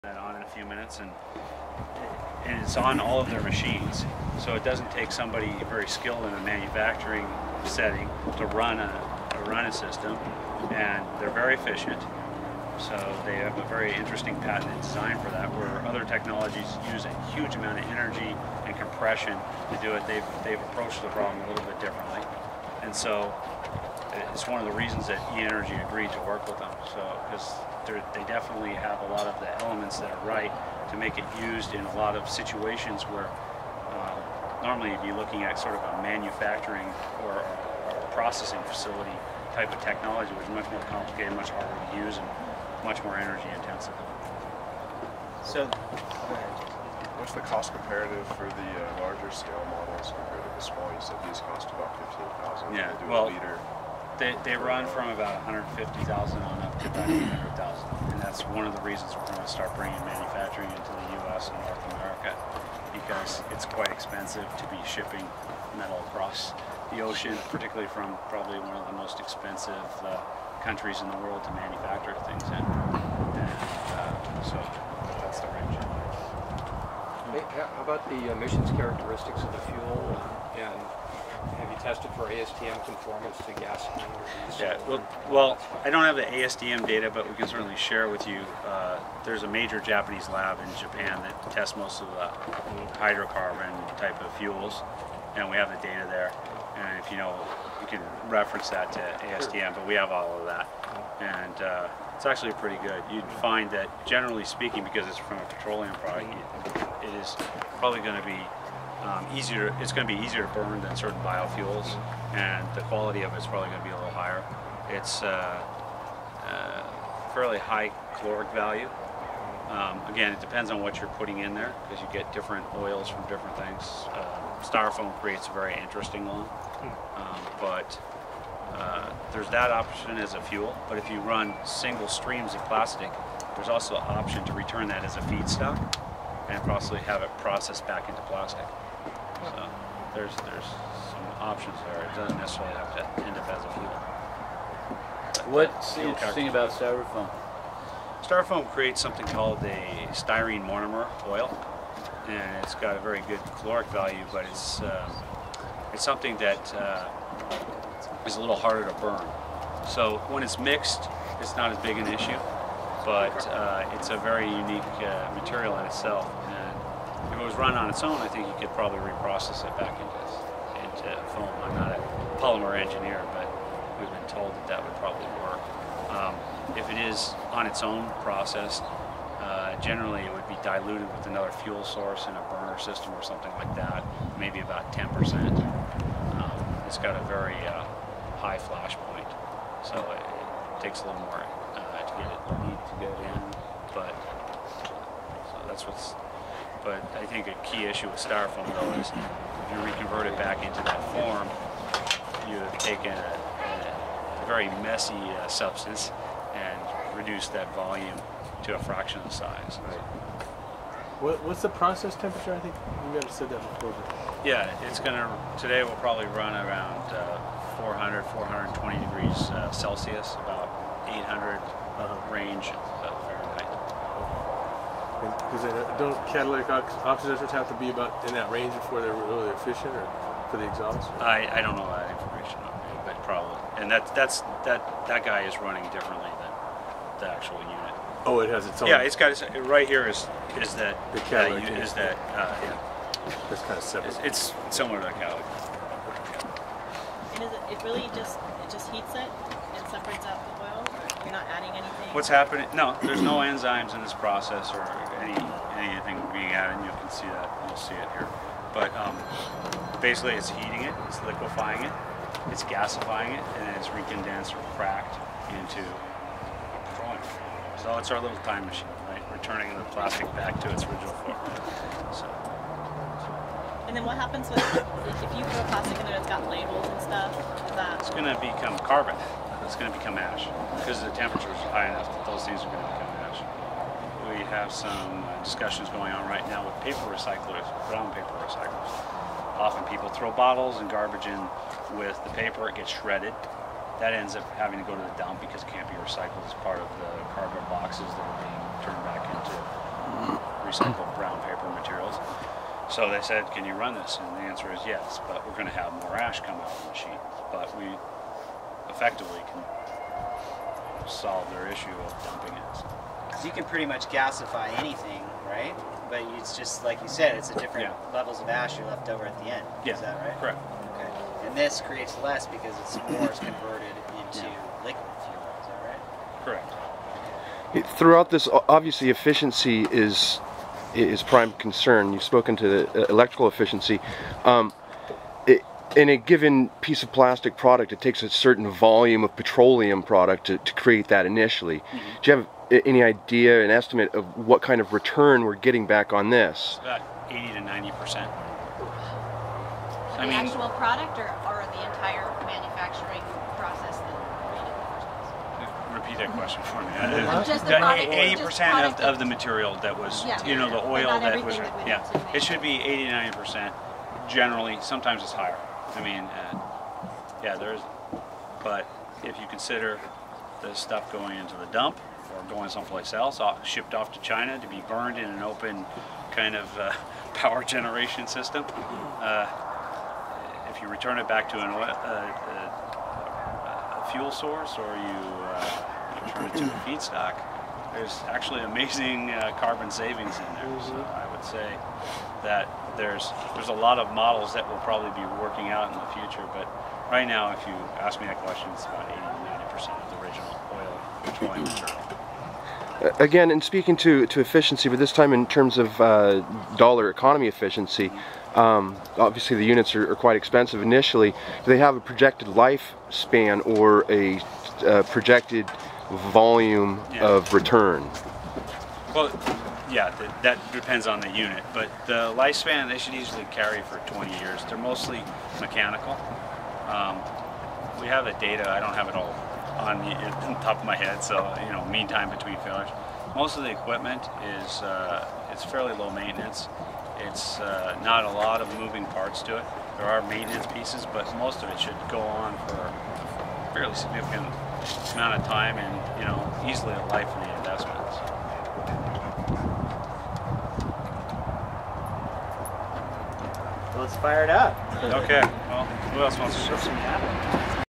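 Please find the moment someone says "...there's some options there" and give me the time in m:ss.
2:20.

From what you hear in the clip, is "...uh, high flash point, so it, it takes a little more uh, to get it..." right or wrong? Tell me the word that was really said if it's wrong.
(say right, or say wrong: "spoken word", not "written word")
right.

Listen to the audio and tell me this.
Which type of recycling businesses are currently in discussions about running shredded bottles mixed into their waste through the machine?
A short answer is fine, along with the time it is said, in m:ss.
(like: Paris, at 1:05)
brown paper recyclers, at 4:47.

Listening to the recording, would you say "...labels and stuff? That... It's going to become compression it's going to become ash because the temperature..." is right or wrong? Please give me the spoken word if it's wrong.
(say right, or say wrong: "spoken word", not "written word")
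wrong: "carbon", not "compression".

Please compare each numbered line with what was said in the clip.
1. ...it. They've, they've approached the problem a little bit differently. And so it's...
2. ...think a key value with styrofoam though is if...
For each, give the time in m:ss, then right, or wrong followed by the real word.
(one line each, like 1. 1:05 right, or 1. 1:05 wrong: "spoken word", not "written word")
1. 0:19 right
2. 3:17 wrong: "issue", not "value".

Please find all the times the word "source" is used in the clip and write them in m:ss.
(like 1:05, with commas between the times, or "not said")
3:01, 6:24.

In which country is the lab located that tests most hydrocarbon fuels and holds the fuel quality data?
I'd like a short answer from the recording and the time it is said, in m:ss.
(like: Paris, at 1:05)
Japan, at 1:30.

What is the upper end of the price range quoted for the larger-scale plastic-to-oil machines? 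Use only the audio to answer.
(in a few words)
200,000.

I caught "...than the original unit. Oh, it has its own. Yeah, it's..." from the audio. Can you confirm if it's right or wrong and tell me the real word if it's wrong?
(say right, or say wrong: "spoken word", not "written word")
wrong: "actual", not "original".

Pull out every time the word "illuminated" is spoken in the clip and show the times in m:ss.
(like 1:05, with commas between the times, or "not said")
not said.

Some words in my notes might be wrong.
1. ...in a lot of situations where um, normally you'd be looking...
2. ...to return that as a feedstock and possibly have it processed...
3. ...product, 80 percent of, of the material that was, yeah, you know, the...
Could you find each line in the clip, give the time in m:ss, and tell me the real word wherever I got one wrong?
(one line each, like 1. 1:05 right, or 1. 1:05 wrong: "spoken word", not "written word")
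1. 0:31 right
2. 2:14 right
3. 5:57 right.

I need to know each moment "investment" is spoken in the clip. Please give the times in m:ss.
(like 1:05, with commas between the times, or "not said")
7:27.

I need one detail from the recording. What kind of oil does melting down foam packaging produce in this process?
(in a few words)
styrene monomer oil.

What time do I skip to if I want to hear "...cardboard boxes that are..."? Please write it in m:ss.
4:57.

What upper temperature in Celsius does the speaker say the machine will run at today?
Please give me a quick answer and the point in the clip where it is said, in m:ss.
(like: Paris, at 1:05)
420 degrees, at 3:38.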